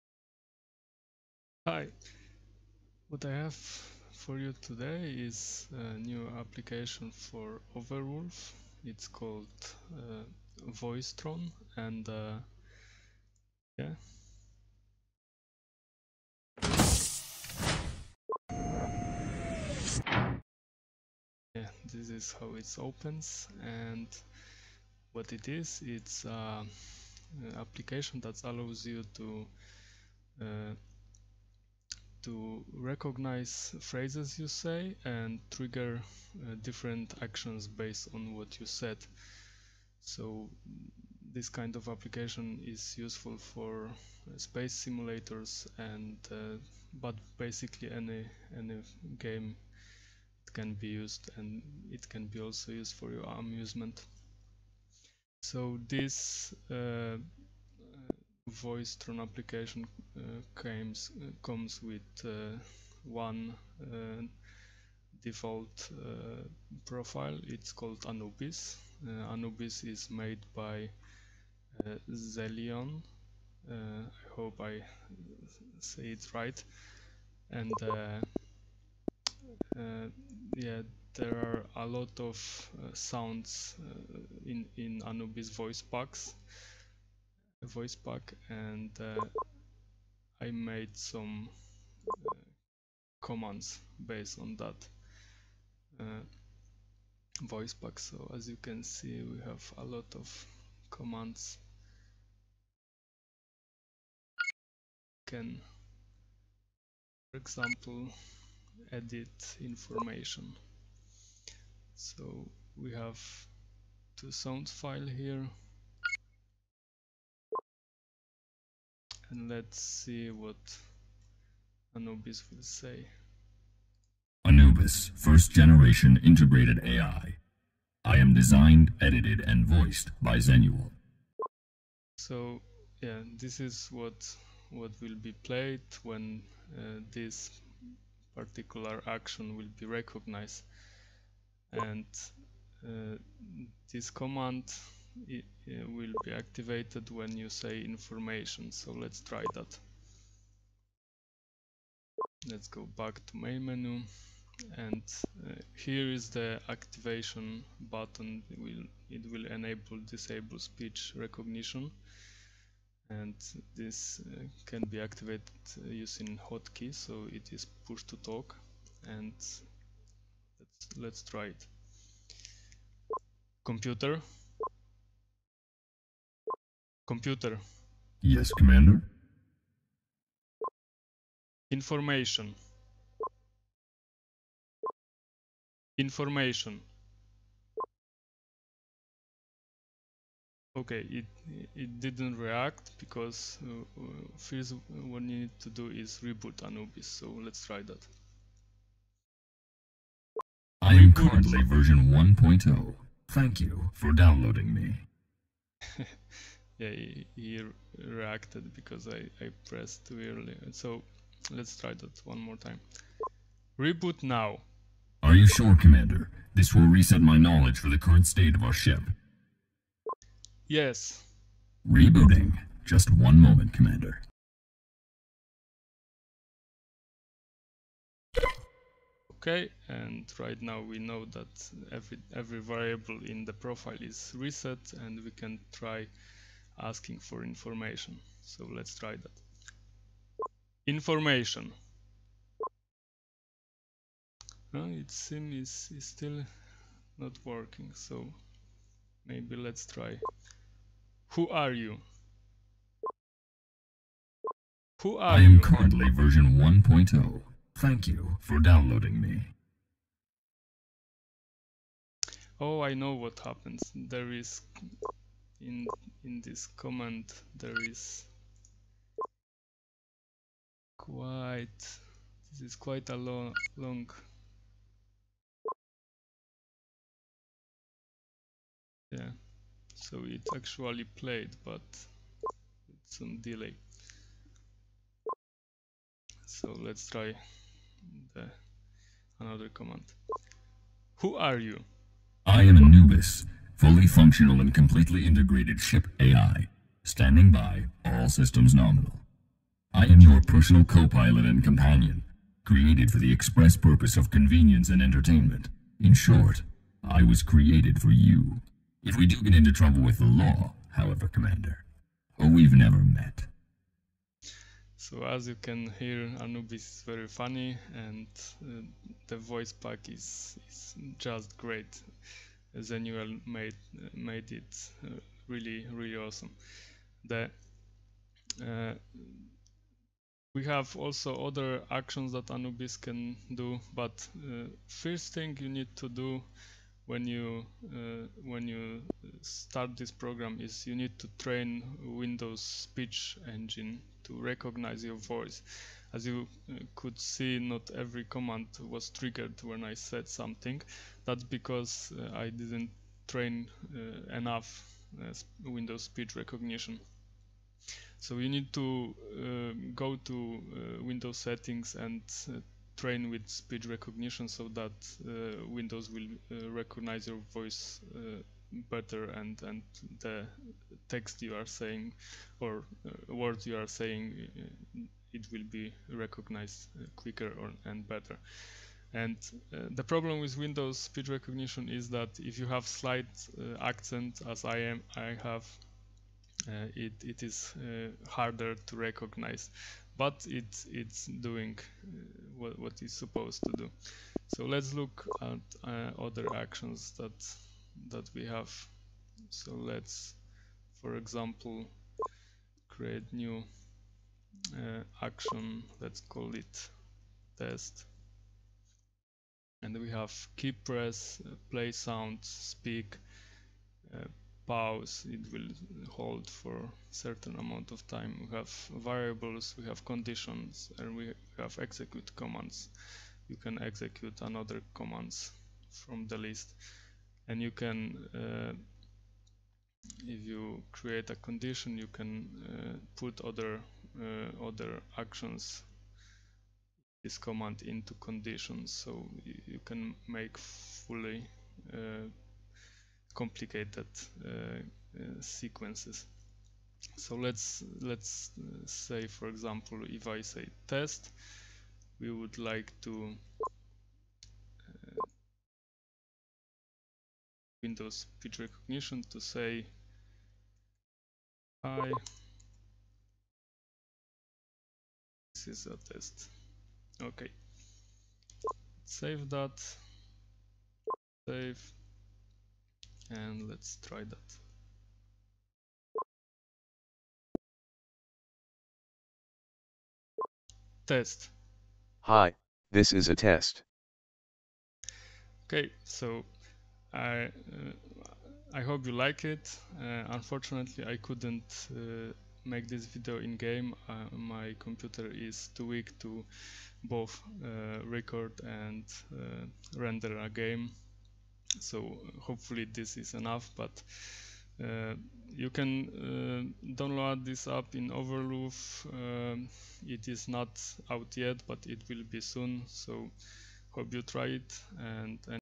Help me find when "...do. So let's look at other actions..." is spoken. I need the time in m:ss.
6:33.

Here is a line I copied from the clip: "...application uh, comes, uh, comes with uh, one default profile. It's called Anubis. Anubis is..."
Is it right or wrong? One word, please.
right.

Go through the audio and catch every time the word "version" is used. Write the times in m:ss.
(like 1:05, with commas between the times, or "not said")
3:21, 4:16.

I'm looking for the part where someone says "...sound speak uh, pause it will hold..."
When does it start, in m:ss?
6:51.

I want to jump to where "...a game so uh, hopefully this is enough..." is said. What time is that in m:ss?
8:20.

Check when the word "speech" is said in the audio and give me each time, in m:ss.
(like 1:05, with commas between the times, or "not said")
2:40, 5:42, 5:56, 6:03, 6:20, 7:38.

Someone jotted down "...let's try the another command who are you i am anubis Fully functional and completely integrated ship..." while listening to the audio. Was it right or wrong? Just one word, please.
right.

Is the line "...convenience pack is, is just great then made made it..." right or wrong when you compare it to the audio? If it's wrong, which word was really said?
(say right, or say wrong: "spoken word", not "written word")
wrong: "voice", not "convenience".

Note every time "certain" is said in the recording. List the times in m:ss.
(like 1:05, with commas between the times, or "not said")
6:57.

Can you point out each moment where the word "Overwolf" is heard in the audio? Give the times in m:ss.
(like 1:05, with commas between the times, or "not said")
0:07, 8:28.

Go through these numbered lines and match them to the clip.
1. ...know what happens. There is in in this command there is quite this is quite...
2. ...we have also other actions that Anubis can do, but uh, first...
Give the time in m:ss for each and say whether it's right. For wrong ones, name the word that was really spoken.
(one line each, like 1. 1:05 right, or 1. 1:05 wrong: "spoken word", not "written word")
1. 4:22 right
2. 5:30 right.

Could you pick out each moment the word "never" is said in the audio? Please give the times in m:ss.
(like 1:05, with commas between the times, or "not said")
5:12.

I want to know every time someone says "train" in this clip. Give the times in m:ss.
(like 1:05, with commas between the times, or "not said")
5:41, 5:53, 6:02.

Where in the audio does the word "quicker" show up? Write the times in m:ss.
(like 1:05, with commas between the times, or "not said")
6:17.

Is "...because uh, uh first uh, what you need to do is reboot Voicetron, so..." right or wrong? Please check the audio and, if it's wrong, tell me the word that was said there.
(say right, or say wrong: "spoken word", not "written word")
wrong: "Anubis", not "Voicetron".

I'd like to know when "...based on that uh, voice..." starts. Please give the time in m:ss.
1:34.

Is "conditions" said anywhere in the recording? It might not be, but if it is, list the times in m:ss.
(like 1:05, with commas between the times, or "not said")
7:00, 7:11, 7:18.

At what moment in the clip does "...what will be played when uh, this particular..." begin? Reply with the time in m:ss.
2:14.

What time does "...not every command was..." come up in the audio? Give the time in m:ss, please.
5:47.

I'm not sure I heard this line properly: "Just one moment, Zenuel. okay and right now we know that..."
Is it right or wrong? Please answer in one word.
wrong.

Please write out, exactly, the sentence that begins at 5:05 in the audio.
In short, I was created for you.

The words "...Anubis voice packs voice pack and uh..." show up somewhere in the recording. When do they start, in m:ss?
1:25.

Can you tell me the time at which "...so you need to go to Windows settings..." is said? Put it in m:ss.
5:58.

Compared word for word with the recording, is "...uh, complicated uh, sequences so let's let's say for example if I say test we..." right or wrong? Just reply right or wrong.
right.